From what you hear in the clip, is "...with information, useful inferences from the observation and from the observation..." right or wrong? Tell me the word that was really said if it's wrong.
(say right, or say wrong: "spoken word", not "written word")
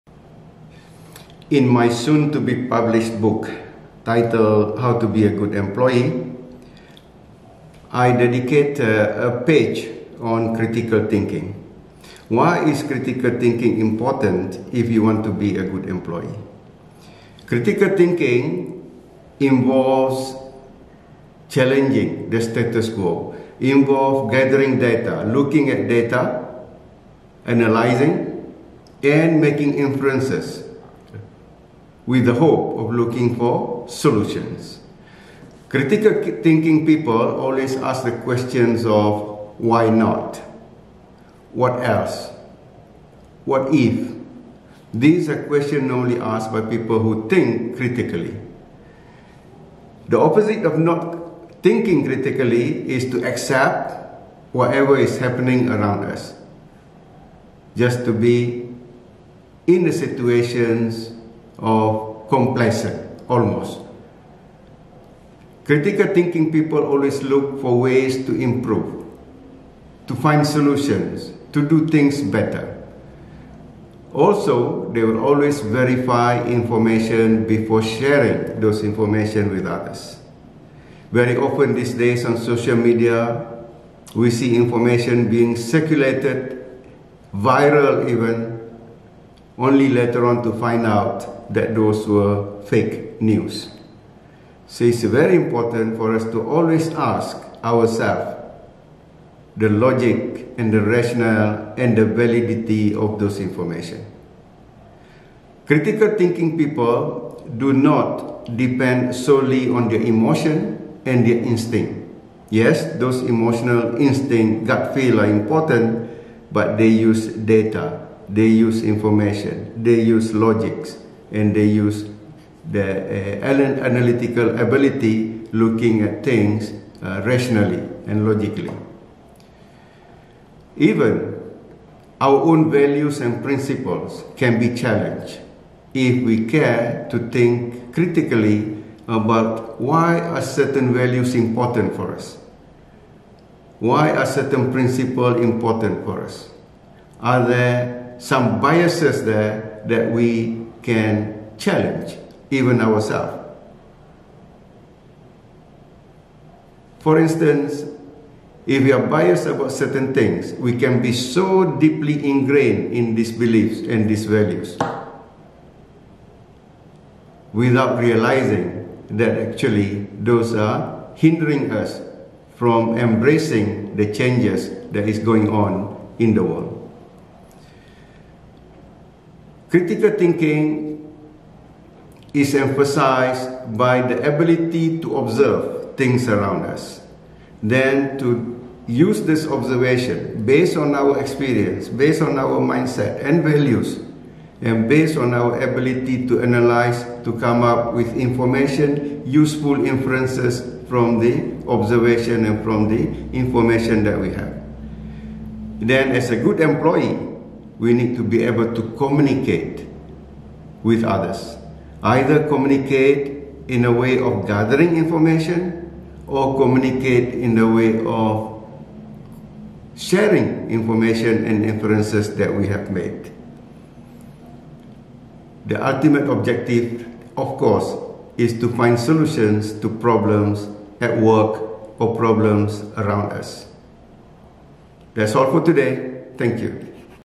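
wrong: "information", not "observation".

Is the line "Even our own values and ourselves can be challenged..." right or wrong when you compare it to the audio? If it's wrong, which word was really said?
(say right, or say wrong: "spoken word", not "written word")
wrong: "principles", not "ourselves".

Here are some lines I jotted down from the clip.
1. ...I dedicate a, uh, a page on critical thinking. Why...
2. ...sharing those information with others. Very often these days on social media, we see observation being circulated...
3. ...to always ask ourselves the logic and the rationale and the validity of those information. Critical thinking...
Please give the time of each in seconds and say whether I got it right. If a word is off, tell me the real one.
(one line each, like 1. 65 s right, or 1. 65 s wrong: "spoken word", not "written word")
1. 7 s right
2. 77 s wrong: "information", not "observation"
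3. 96 s right.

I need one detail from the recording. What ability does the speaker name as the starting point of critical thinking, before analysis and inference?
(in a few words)
to observe.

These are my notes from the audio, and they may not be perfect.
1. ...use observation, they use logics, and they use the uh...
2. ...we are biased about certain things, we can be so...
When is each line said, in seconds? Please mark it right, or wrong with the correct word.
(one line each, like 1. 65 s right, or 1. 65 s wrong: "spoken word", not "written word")
1. 118 s wrong: "information", not "observation"
2. 158 s right.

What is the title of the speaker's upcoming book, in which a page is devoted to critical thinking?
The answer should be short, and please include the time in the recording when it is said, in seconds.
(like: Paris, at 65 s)
How to Be a Good Employee, at 4 s.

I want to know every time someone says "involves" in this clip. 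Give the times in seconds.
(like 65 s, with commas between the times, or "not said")
19 s, 23 s.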